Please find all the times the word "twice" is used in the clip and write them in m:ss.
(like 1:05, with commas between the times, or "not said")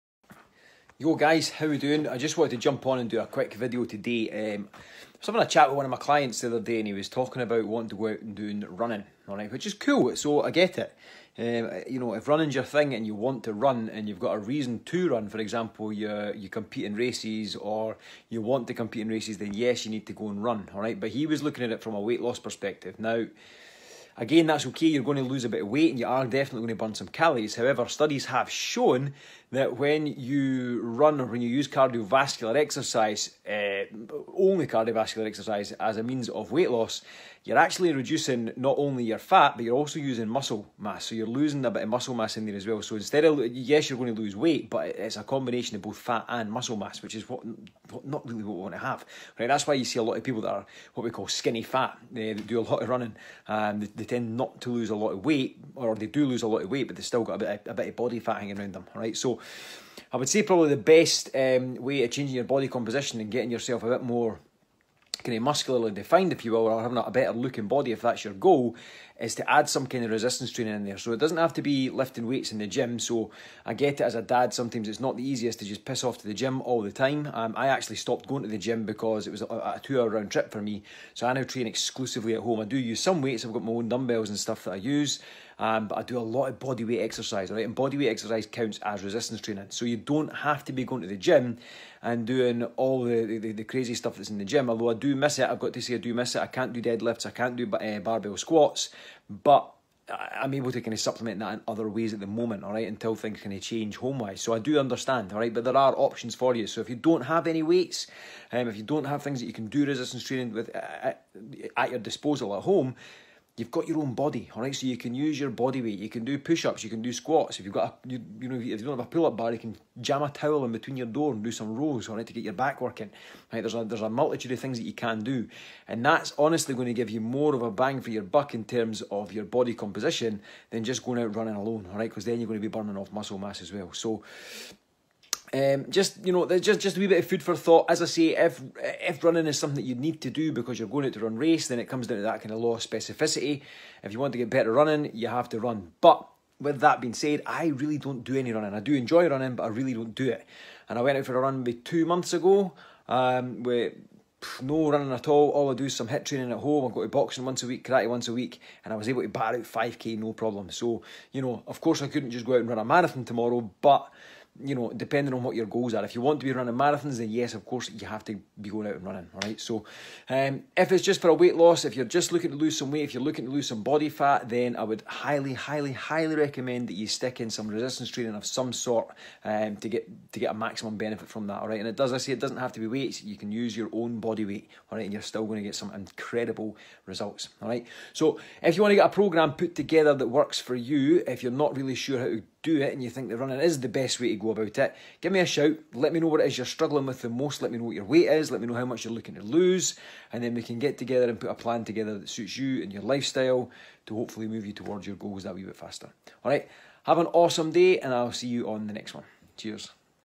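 not said.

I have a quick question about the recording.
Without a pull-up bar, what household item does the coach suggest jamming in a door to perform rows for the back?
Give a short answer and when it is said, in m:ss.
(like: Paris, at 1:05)
A towel, at 2:00.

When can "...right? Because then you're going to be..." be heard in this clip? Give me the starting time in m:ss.
2:11.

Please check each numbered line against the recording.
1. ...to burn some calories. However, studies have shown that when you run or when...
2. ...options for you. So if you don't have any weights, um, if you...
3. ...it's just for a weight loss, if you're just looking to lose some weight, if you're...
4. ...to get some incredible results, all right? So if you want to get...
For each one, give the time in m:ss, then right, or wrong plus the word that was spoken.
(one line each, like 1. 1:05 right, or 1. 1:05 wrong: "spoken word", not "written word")
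1. 0:26 right
2. 1:45 right
3. 2:50 right
4. 3:05 right.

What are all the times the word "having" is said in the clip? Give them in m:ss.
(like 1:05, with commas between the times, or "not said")
0:05, 1:06.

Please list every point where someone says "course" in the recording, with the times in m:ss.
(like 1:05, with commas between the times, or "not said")
2:41, 2:47.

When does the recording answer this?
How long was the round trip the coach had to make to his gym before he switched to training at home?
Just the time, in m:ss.
1:19.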